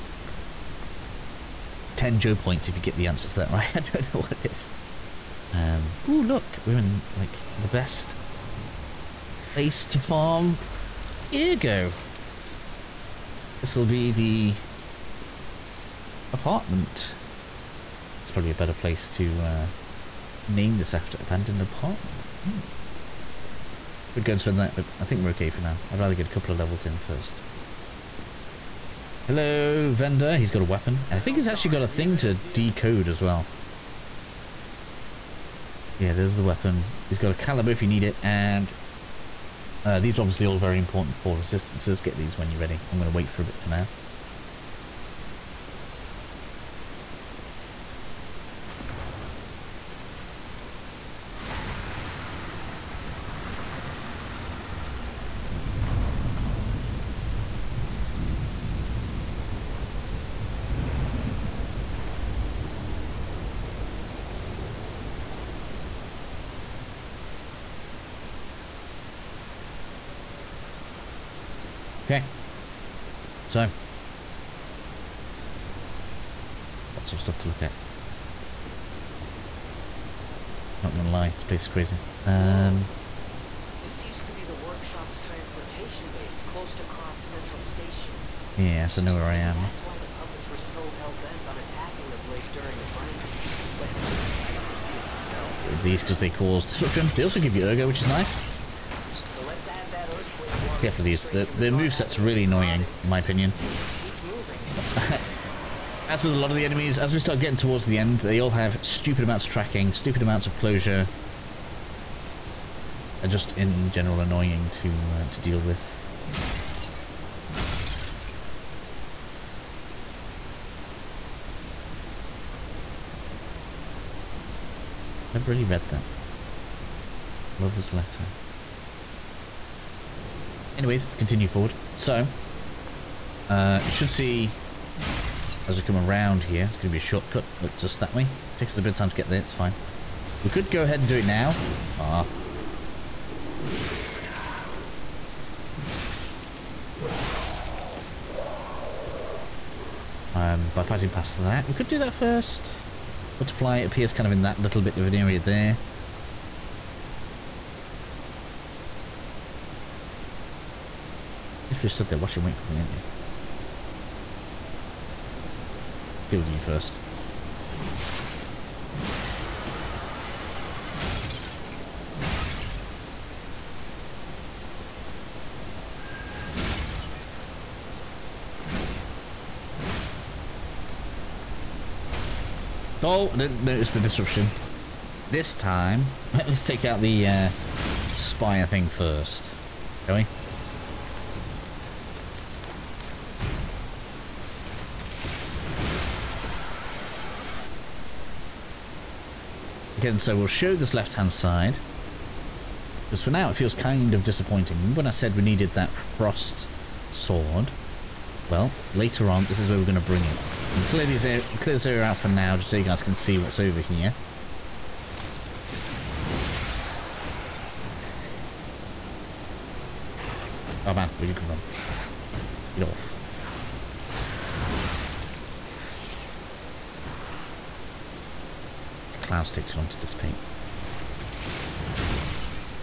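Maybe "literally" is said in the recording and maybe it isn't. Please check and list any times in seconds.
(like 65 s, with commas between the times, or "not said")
161 s.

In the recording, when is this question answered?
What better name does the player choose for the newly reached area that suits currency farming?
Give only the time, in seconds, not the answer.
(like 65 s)
21 s.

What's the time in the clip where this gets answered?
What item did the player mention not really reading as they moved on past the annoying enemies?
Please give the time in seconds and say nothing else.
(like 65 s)
127 s.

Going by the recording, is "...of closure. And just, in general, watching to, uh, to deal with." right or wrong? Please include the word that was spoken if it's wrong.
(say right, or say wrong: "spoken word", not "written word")
wrong: "annoying", not "watching".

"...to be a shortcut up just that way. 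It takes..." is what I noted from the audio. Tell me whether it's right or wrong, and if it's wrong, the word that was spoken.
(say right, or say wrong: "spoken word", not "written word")
right.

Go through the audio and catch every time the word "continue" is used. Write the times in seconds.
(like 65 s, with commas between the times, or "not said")
131 s.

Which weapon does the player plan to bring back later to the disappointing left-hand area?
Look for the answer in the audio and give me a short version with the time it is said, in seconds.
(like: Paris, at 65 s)
frost sword, at 205 s.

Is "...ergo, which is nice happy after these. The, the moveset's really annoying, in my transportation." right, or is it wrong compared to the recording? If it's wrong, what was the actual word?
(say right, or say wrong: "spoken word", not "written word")
wrong: "opinion", not "transportation".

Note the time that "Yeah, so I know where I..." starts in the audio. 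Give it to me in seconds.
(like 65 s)
88 s.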